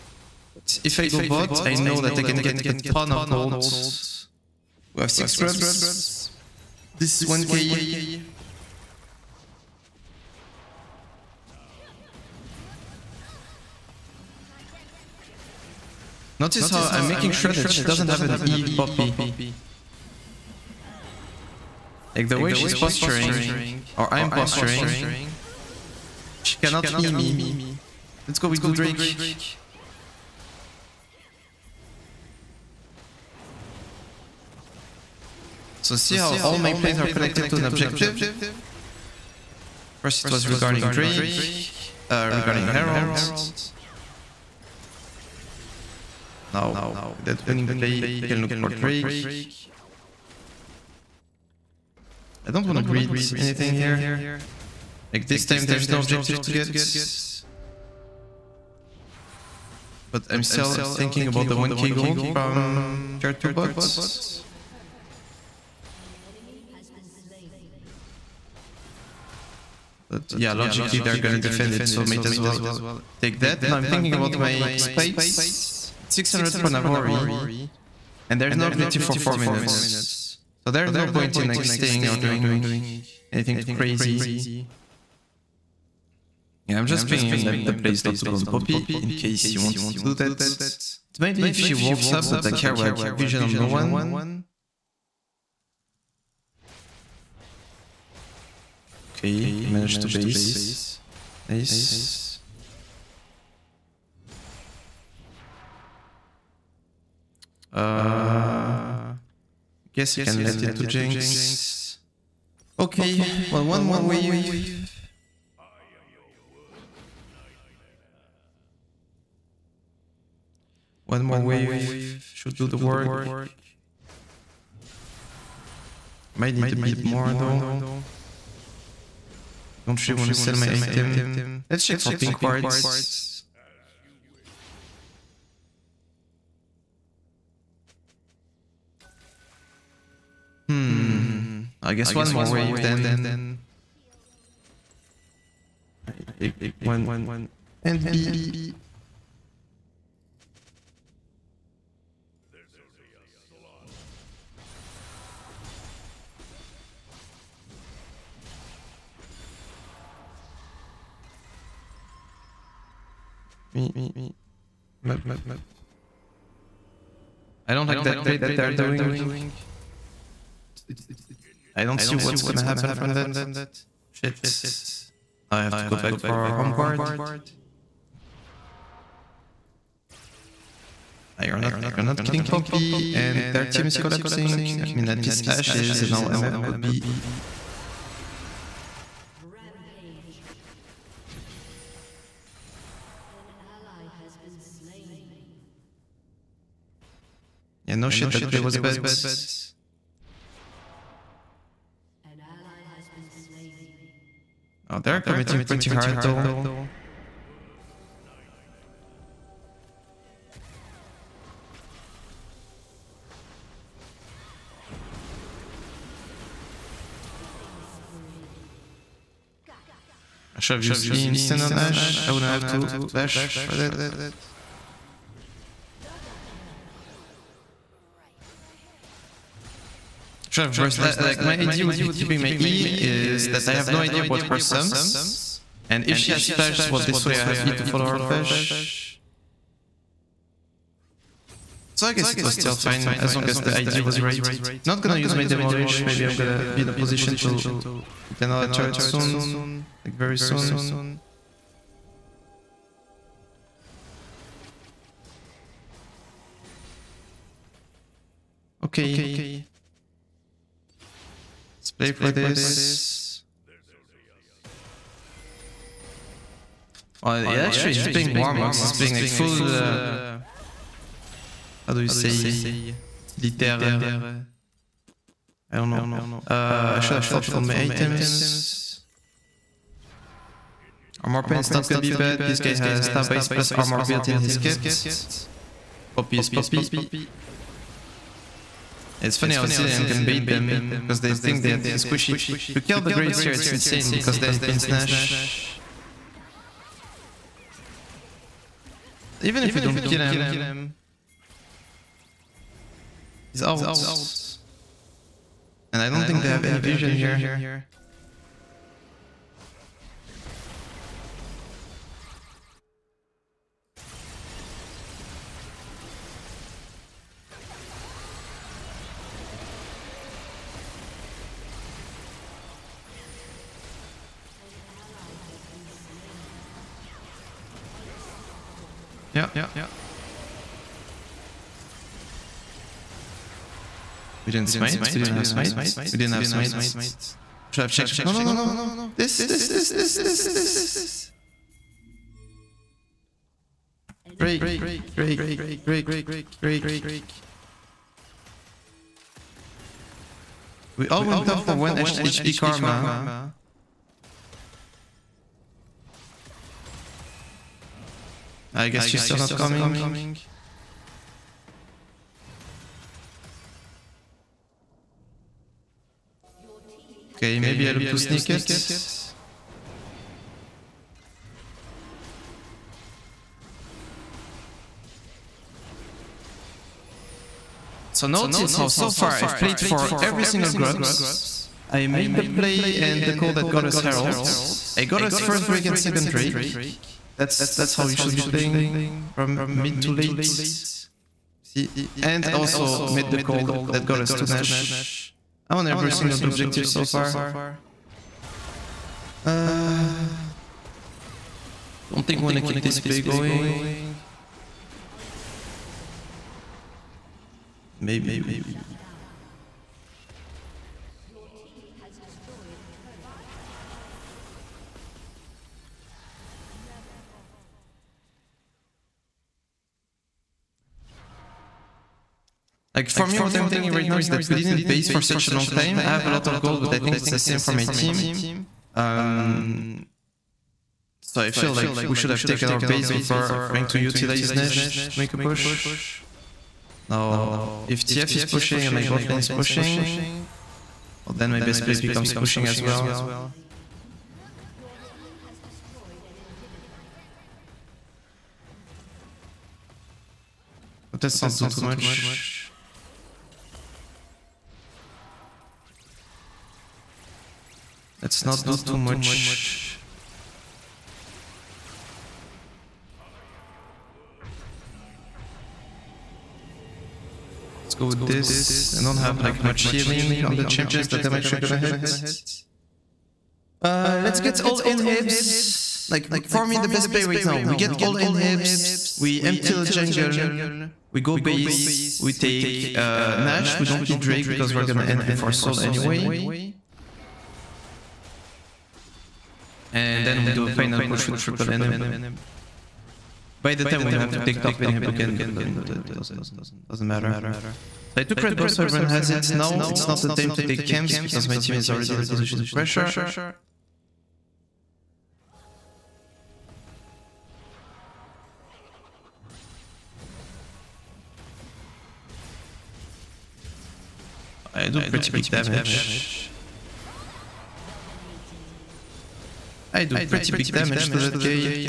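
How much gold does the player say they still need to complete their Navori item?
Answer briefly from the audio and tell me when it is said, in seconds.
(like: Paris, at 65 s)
600, at 76 s.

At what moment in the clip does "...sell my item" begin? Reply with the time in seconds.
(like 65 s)
130 s.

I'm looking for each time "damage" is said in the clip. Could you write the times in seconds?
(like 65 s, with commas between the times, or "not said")
515 s, 520 s.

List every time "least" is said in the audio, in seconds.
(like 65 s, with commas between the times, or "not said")
185 s.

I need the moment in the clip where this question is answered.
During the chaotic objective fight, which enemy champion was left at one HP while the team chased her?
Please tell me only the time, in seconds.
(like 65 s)
351 s.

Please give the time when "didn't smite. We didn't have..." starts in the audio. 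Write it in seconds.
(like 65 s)
334 s.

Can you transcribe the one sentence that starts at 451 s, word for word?
But let's not do too much.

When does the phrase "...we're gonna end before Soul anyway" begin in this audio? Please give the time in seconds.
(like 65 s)
484 s.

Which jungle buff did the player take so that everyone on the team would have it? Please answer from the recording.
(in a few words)
Red buff.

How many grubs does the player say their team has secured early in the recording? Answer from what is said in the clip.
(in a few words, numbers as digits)
6.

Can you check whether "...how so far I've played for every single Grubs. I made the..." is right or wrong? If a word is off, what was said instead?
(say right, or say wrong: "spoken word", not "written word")
right.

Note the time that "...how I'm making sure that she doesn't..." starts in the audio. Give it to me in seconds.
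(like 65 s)
16 s.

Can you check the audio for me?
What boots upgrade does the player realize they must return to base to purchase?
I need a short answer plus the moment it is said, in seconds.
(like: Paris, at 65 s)
Home guard, at 176 s.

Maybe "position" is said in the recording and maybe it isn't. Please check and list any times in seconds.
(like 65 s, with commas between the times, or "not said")
246 s, 502 s.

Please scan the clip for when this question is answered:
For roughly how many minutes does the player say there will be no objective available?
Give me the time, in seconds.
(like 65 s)
79 s.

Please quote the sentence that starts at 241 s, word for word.
So I guess it was still fine as long as the ID was right.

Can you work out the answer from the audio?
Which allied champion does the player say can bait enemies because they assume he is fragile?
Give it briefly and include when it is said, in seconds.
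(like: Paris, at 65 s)
Zilean, at 289 s.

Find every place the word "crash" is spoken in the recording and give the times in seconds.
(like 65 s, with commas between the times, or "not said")
not said.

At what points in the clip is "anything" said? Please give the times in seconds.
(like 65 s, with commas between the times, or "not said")
53 s, 83 s.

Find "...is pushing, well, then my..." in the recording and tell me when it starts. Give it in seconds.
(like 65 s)
439 s.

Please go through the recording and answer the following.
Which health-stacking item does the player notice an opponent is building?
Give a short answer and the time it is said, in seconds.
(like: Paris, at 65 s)
Warmog's, at 268 s.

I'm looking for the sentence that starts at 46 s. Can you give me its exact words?
Now, that winning play, we can look for Drake.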